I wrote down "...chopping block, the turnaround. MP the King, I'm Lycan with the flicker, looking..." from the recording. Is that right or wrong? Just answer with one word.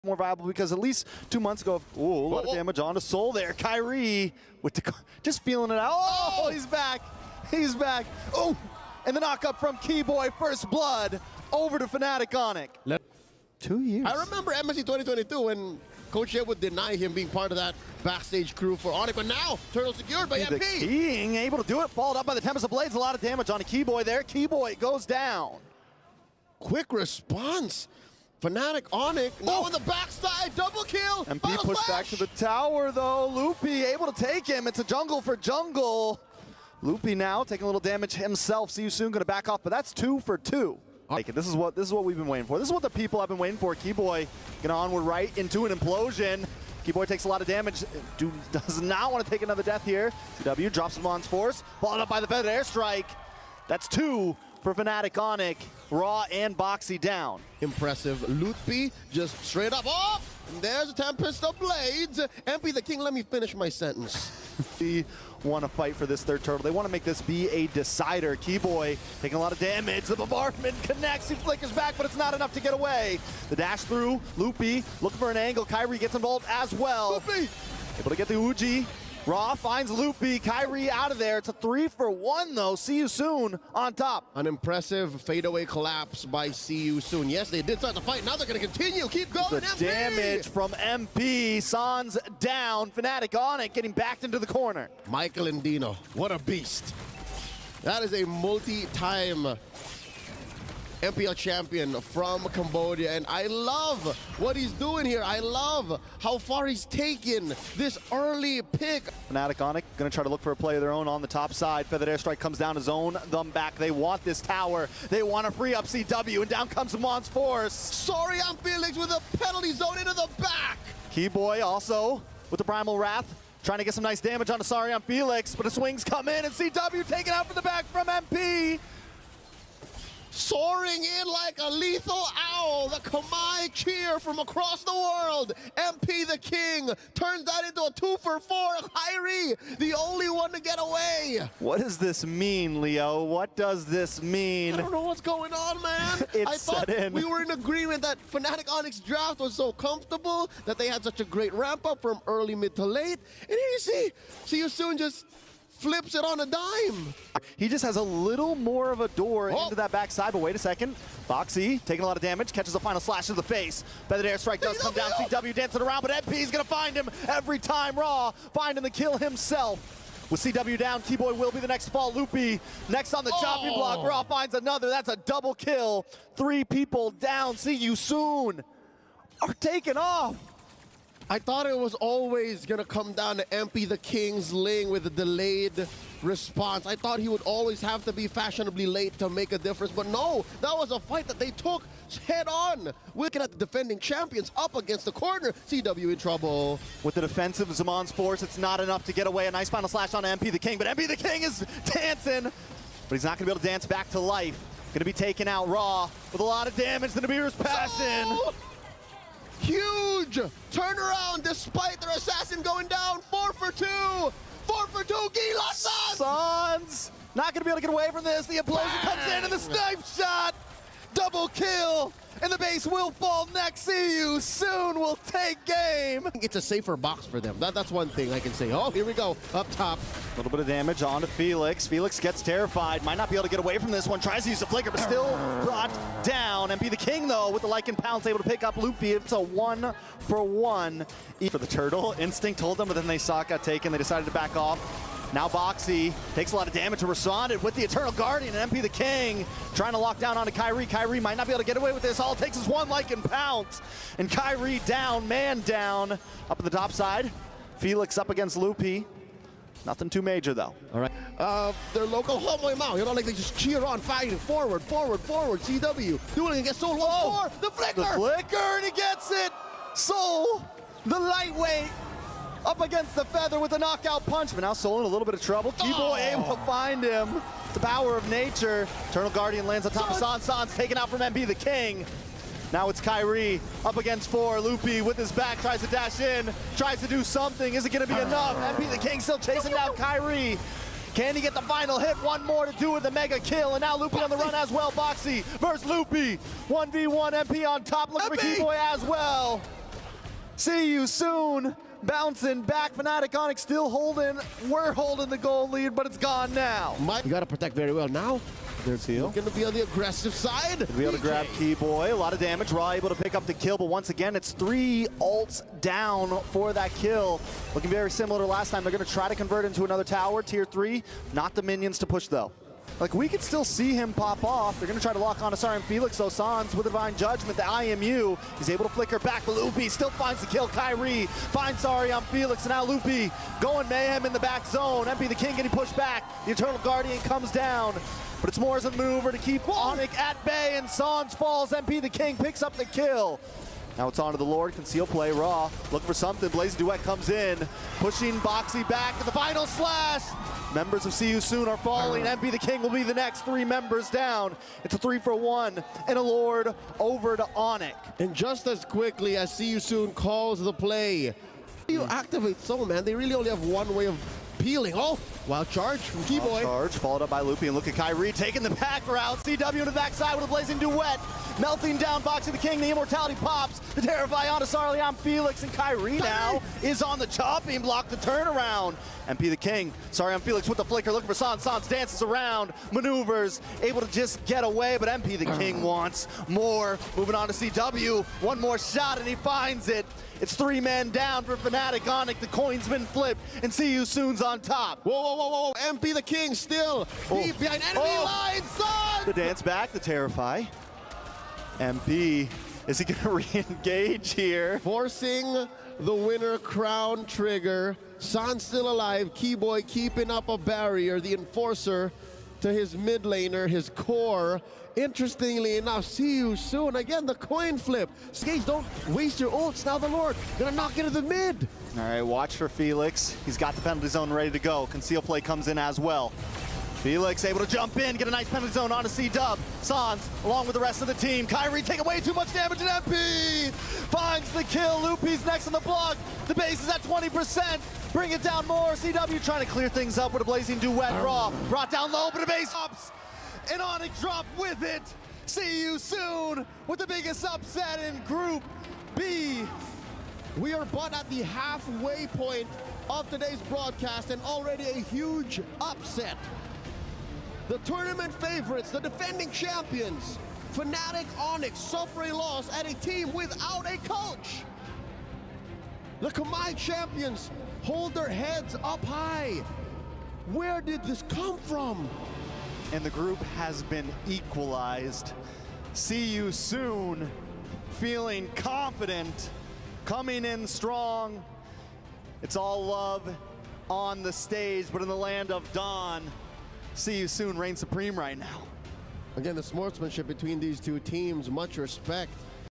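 wrong.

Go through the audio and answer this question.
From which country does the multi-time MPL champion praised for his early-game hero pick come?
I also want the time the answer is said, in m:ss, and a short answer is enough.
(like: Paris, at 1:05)
Cambodia, at 1:42.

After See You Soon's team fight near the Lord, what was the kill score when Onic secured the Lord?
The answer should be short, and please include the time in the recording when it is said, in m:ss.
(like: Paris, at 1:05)
3 for 1, at 5:54.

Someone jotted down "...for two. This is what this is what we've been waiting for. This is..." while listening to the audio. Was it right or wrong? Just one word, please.
right.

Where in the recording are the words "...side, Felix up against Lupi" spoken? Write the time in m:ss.
4:16.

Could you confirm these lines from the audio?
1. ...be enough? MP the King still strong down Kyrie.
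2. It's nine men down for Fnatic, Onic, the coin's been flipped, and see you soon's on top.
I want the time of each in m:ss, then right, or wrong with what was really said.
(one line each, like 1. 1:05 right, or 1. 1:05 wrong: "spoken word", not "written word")
1. 4:48 wrong: "chasing", not "strong"
2. 6:30 wrong: "three", not "nine".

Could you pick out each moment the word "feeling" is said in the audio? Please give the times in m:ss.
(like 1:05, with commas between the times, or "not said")
0:05, 7:58.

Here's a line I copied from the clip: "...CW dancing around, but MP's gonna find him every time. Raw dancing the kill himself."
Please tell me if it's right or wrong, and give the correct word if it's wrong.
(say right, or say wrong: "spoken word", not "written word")
wrong: "finding", not "dancing".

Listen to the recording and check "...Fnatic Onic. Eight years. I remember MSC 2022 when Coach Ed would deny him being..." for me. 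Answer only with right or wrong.
wrong.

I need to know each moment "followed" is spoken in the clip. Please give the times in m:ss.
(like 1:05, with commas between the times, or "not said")
0:21, 0:51, 6:06.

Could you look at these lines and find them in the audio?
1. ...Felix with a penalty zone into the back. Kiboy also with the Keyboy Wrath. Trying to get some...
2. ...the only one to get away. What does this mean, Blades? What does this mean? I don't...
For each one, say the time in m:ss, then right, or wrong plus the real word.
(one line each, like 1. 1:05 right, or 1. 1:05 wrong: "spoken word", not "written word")
1. 1:58 wrong: "Primal", not "Keyboy"
2. 2:19 wrong: "Leo", not "Blades".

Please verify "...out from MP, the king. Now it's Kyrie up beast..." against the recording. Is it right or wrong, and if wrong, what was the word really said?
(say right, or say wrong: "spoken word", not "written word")
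wrong: "against", not "beast".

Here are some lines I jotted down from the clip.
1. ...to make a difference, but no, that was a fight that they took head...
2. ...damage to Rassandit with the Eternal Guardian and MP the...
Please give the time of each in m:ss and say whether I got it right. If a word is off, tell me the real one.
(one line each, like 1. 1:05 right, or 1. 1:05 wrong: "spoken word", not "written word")
1. 3:09 right
2. 4:06 right.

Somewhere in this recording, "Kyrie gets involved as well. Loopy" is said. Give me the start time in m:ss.
1:15.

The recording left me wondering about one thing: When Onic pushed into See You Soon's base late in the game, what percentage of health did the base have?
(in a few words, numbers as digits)
20%.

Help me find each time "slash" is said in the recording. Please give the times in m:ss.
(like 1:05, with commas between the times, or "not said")
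2:43, 3:19, 5:49.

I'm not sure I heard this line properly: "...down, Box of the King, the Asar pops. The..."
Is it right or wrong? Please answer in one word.
wrong.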